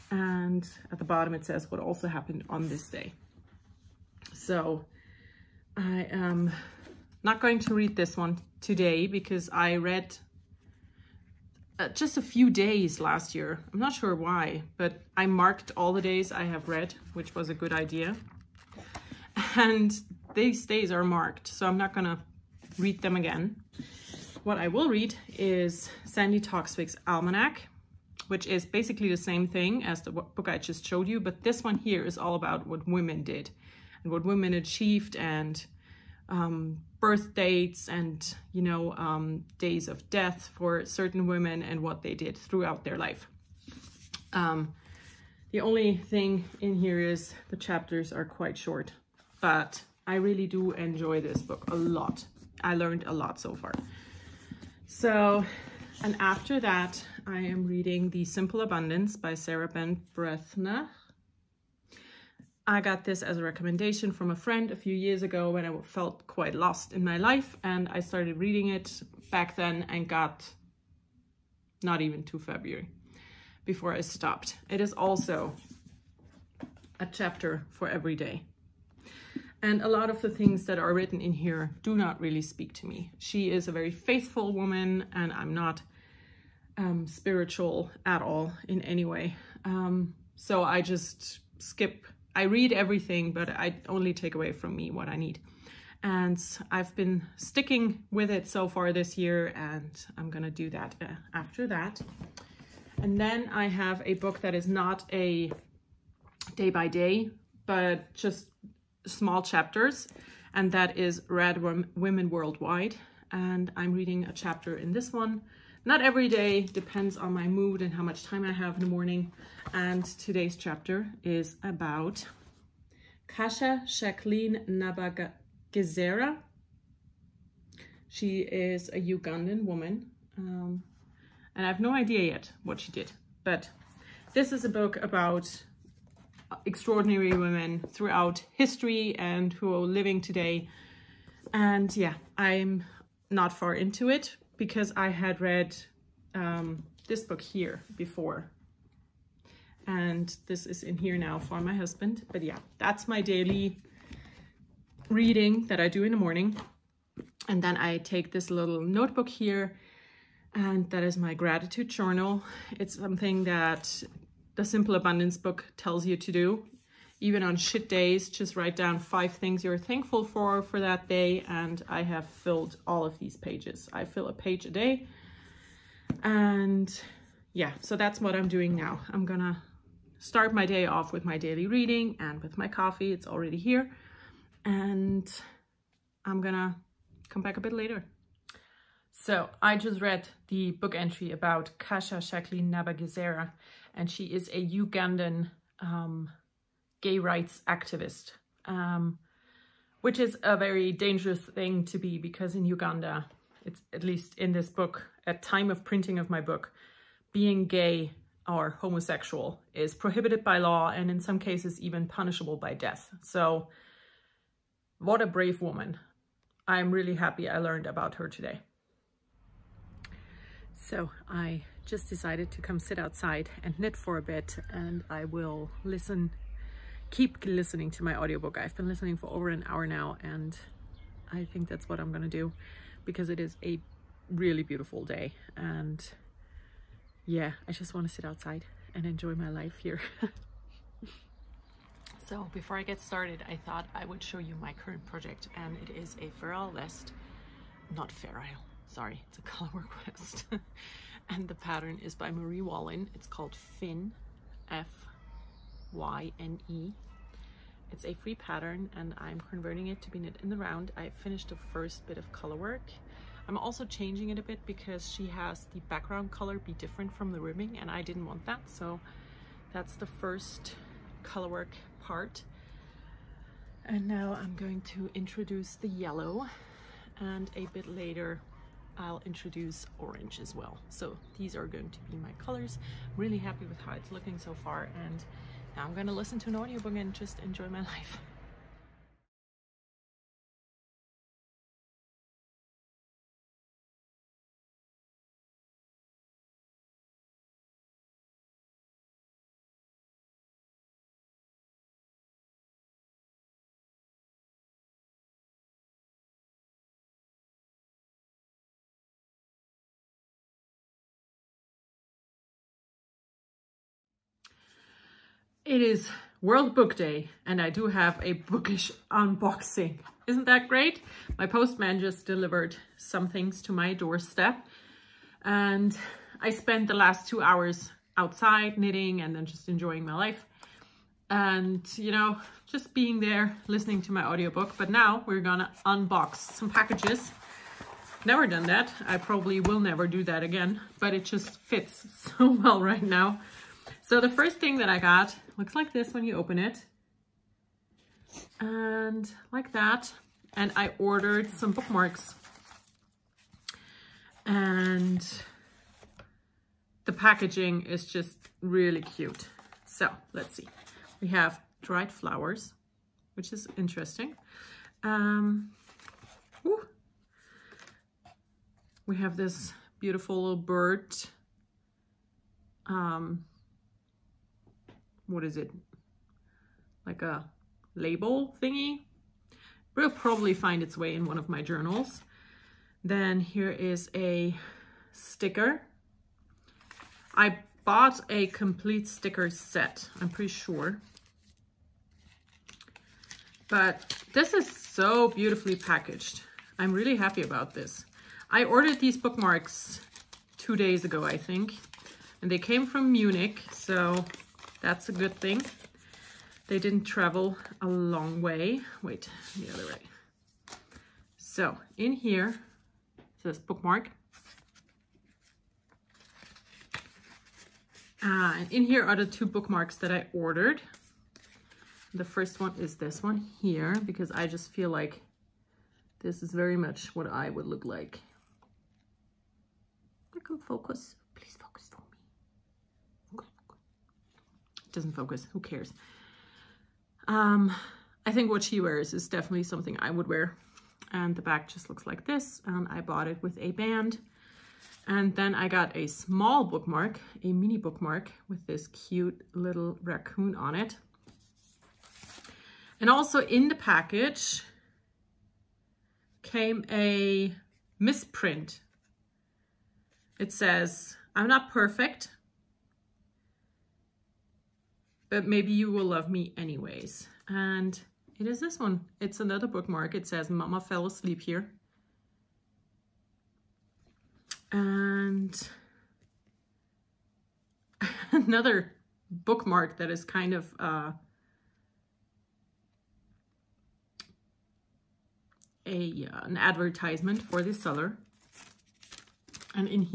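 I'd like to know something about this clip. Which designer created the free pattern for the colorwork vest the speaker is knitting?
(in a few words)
Marie Wallin.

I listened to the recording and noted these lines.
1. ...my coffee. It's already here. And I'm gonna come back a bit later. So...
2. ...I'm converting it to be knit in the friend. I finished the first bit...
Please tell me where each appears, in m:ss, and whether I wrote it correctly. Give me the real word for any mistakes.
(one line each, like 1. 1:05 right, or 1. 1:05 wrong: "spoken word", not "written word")
1. 3:02 right
2. 4:19 wrong: "round", not "friend".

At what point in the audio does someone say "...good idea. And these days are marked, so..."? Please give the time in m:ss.
0:17.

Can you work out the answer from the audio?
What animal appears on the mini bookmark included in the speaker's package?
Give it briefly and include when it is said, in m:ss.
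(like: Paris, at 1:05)
raccoon, at 7:30.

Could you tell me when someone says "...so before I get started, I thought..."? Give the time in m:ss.
4:02.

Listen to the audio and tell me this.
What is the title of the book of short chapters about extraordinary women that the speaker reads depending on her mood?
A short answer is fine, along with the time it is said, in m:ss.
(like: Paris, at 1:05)
Rad Women Worldwide, at 1:51.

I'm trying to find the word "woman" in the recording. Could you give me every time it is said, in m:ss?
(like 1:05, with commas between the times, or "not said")
1:24, 2:09, 3:35.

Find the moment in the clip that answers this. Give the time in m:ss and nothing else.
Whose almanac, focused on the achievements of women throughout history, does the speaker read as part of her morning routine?
0:26.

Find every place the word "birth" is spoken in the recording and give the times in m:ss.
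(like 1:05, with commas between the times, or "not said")
0:36.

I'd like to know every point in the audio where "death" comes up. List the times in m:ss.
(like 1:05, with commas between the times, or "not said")
0:40, 3:32.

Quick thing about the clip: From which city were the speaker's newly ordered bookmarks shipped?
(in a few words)
Munich.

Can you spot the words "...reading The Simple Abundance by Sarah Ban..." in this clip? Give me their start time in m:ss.
0:57.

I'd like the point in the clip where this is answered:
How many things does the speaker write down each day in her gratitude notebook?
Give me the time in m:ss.
2:48.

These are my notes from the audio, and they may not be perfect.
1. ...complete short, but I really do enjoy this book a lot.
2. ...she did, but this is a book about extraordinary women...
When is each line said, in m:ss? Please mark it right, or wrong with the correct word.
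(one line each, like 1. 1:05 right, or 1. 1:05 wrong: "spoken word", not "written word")
1. 0:48 wrong: "quite", not "complete"
2. 2:12 right.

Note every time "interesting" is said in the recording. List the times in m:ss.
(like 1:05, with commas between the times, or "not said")
6:03.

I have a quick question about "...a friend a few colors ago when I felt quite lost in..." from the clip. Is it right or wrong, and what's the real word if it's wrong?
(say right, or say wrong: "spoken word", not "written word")
wrong: "years", not "colors".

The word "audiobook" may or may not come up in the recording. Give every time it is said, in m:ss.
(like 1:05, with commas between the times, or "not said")
3:48, 4:46, 5:34.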